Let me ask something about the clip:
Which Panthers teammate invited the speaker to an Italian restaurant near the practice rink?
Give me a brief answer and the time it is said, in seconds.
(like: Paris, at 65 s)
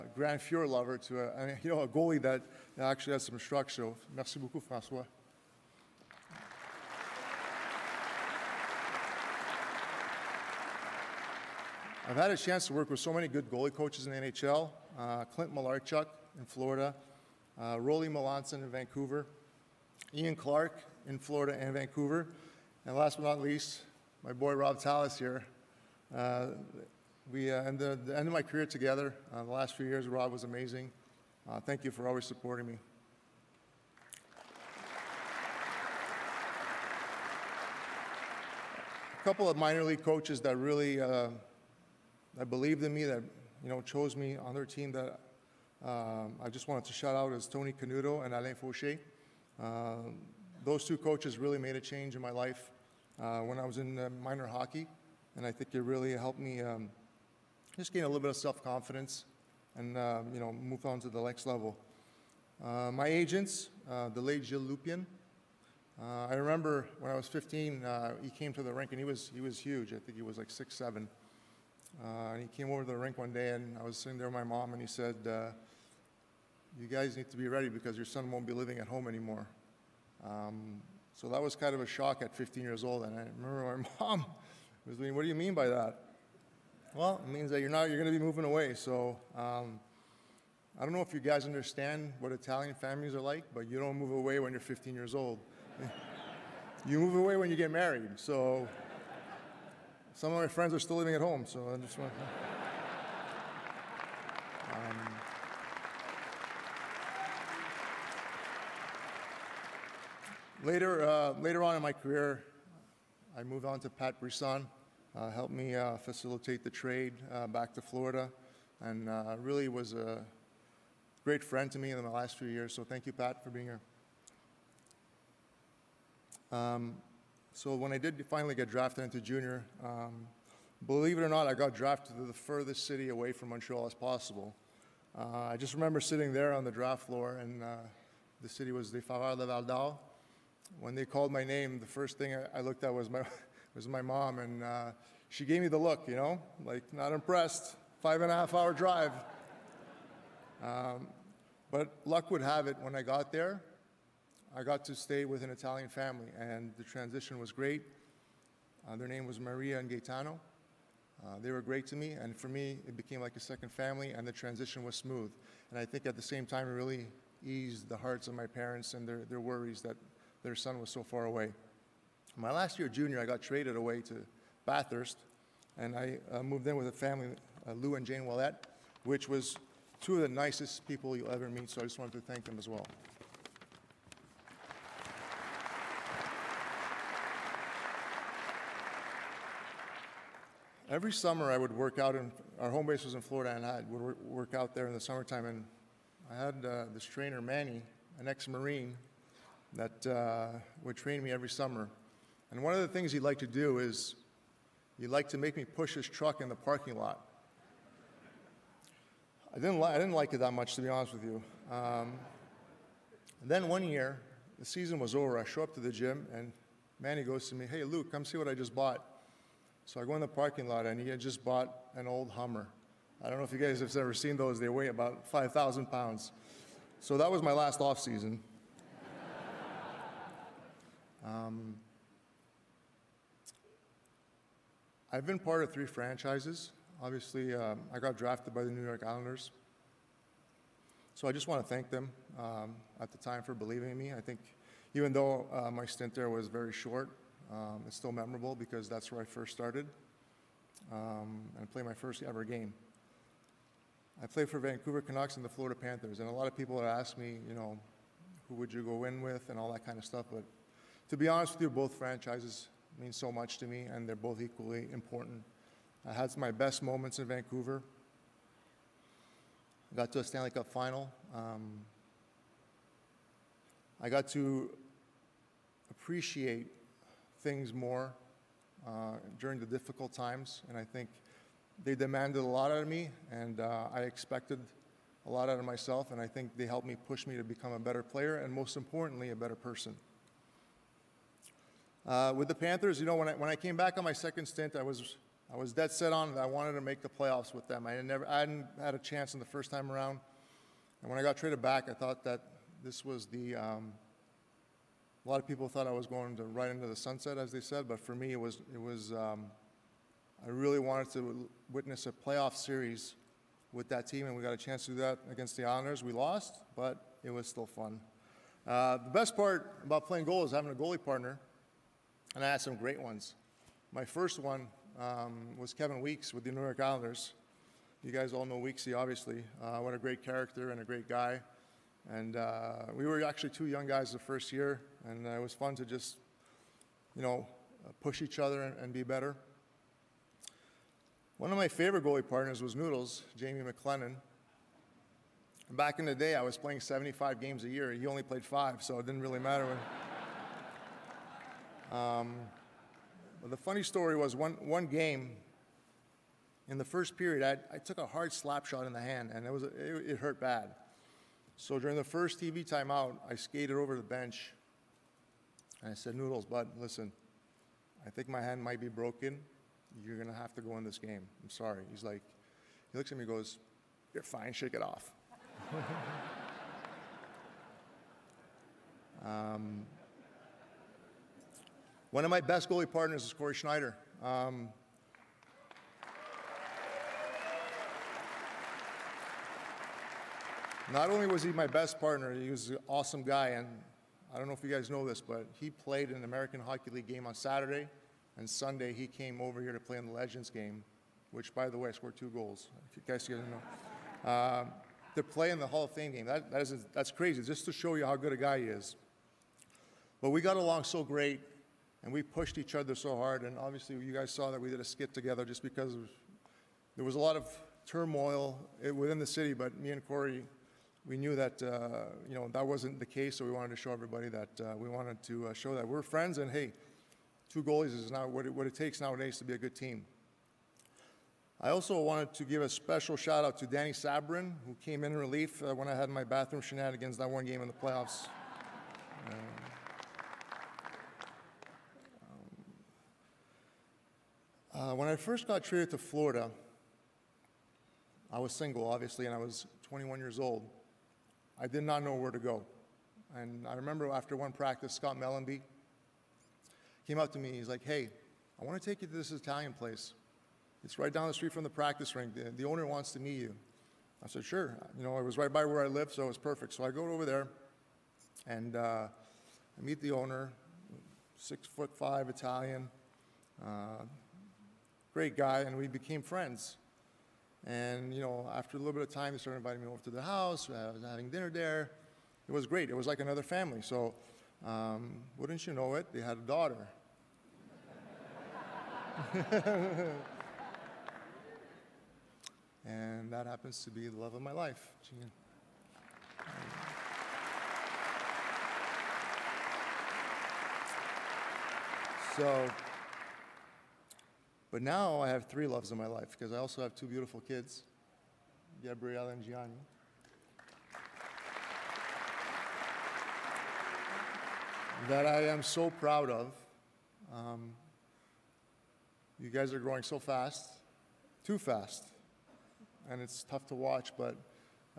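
Scott Mellanby, at 454 s.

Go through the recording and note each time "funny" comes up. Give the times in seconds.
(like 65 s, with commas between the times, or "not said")
353 s.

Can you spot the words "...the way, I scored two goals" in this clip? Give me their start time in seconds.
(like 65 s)
401 s.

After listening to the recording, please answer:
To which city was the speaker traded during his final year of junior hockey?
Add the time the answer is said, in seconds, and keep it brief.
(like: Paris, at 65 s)
Bathurst, at 174 s.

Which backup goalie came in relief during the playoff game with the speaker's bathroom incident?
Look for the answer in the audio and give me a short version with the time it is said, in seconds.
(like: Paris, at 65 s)
Dany Sabourin, at 433 s.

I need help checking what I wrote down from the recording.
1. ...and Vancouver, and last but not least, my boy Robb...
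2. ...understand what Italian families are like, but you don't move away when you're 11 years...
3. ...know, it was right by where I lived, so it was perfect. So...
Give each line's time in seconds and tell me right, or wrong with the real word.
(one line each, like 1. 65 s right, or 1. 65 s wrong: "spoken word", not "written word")
1. 21 s right
2. 91 s wrong: "15", not "11"
3. 465 s right.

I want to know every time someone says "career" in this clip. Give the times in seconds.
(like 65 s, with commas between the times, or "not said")
28 s, 111 s.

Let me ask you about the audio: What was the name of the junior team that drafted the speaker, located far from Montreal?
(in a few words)
Foreurs de Val.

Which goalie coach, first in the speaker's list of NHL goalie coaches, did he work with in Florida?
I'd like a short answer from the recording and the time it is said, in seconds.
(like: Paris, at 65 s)
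Clint Malarchuk, at 15 s.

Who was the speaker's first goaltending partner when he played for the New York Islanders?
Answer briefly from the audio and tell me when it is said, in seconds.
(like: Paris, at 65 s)
Kevin Weeks, at 325 s.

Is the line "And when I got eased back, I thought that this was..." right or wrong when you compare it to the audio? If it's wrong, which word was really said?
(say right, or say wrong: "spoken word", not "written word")
wrong: "traded", not "eased".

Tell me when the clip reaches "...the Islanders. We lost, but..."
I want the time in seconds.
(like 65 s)
315 s.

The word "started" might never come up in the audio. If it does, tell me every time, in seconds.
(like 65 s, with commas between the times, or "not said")
249 s, 479 s.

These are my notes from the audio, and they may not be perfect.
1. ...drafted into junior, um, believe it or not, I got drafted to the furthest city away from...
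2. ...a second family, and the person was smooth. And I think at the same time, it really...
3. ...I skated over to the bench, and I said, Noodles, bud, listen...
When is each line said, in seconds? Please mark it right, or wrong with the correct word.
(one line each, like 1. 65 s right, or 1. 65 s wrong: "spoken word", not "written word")
1. 128 s right
2. 163 s wrong: "transition", not "person"
3. 363 s right.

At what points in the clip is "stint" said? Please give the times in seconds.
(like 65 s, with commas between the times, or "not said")
245 s, 294 s.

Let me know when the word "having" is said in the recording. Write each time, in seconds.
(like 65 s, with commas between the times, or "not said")
320 s, 481 s.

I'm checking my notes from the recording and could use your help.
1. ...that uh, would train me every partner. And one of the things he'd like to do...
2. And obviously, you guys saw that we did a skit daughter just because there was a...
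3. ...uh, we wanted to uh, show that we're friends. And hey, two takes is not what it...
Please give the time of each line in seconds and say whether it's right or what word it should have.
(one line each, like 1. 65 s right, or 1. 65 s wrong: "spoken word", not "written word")
1. 199 s wrong: "summer", not "partner"
2. 413 s wrong: "together", not "daughter"
3. 424 s wrong: "goalies", not "takes".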